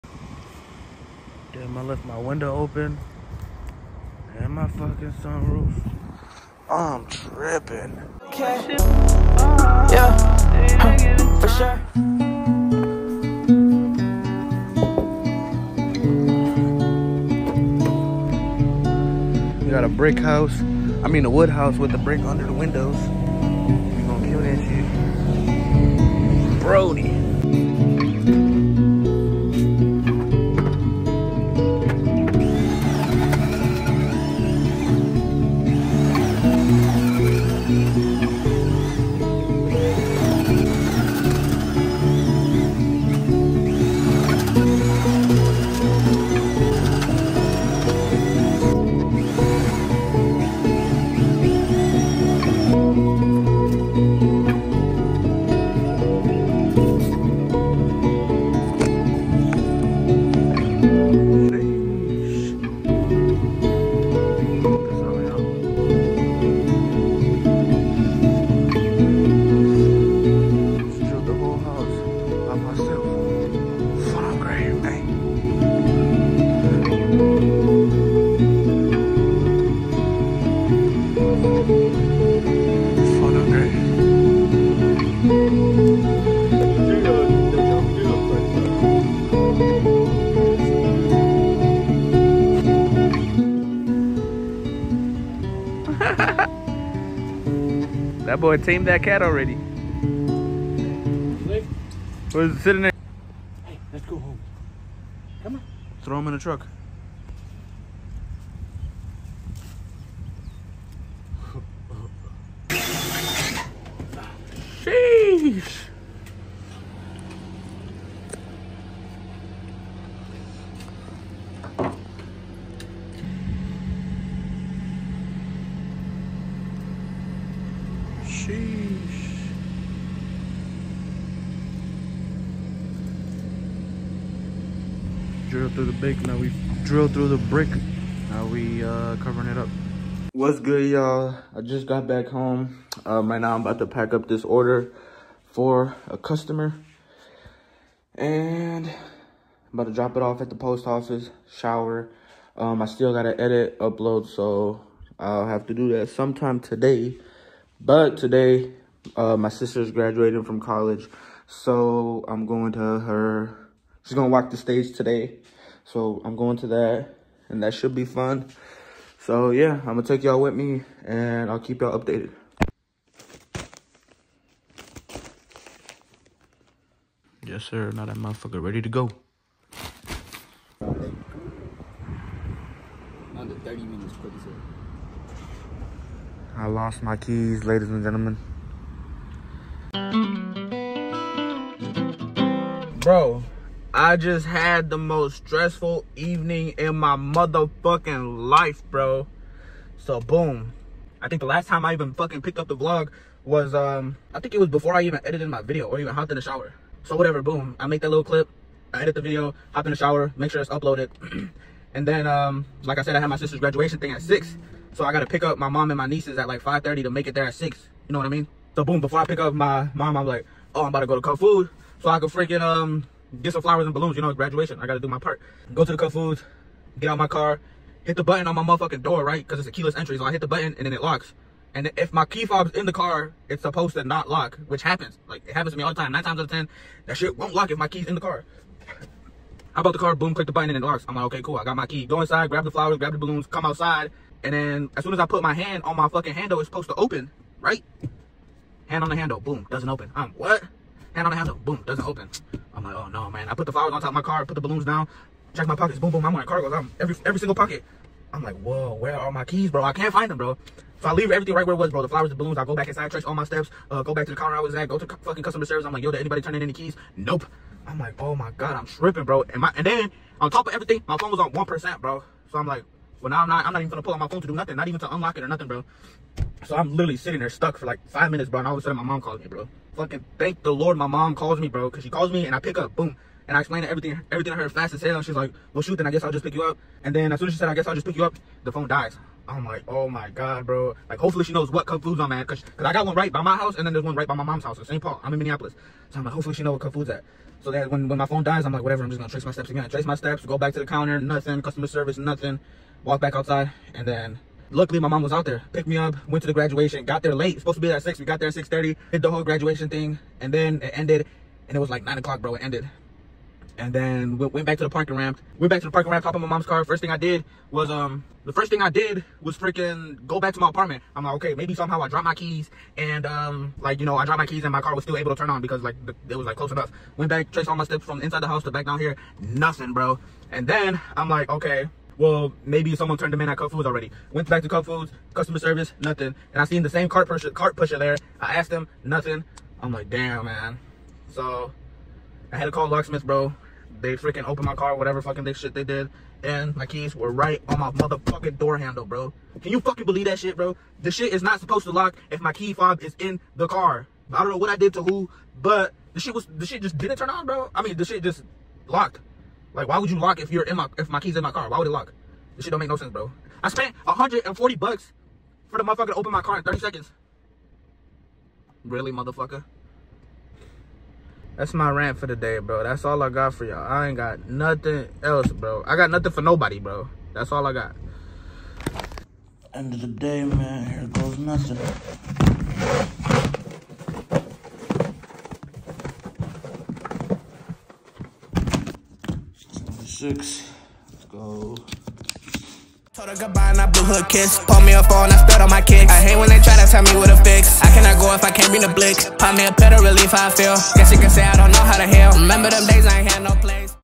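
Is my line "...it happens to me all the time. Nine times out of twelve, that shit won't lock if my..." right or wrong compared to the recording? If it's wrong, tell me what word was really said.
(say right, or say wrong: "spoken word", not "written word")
wrong: "ten", not "twelve".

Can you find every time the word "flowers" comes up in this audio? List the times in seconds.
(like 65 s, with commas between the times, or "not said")
223 s, 242 s, 253 s, 262 s.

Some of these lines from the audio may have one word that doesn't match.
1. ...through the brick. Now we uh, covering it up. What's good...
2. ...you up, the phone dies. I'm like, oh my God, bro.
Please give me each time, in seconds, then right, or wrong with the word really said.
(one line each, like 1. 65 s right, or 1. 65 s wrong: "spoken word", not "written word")
1. 137 s right
2. 288 s right.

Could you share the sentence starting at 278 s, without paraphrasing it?
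And all of a sudden my mom calls me, bro.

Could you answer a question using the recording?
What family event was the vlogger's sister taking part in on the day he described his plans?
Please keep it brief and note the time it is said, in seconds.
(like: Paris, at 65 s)
Graduating from college, at 159 s.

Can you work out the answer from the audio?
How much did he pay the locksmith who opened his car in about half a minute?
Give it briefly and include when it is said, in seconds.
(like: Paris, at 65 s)
$140, at 364 s.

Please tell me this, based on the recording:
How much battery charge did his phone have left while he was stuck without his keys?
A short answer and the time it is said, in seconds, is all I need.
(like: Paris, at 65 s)
1%, at 271 s.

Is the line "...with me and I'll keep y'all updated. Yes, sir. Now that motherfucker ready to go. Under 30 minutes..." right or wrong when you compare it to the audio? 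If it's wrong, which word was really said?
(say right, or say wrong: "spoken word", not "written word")
right.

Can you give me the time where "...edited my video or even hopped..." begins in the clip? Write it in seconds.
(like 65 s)
205 s.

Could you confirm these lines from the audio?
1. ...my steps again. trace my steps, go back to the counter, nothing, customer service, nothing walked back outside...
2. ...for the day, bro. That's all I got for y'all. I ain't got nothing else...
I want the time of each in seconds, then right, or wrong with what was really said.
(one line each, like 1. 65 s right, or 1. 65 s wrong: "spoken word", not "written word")
1. 299 s right
2. 372 s right.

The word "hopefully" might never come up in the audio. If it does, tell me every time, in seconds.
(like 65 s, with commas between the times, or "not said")
291 s, 296 s.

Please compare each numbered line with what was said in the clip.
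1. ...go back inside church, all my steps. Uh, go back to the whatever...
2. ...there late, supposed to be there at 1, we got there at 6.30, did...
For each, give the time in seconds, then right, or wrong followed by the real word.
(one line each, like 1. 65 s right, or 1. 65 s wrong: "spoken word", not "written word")
1. 262 s wrong: "counter", not "whatever"
2. 307 s wrong: "6", not "1".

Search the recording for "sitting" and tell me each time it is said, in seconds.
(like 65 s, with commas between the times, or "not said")
102 s, 277 s.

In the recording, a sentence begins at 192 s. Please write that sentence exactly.
Bro, I just had the most stressful evening in my motherfucking life, bro.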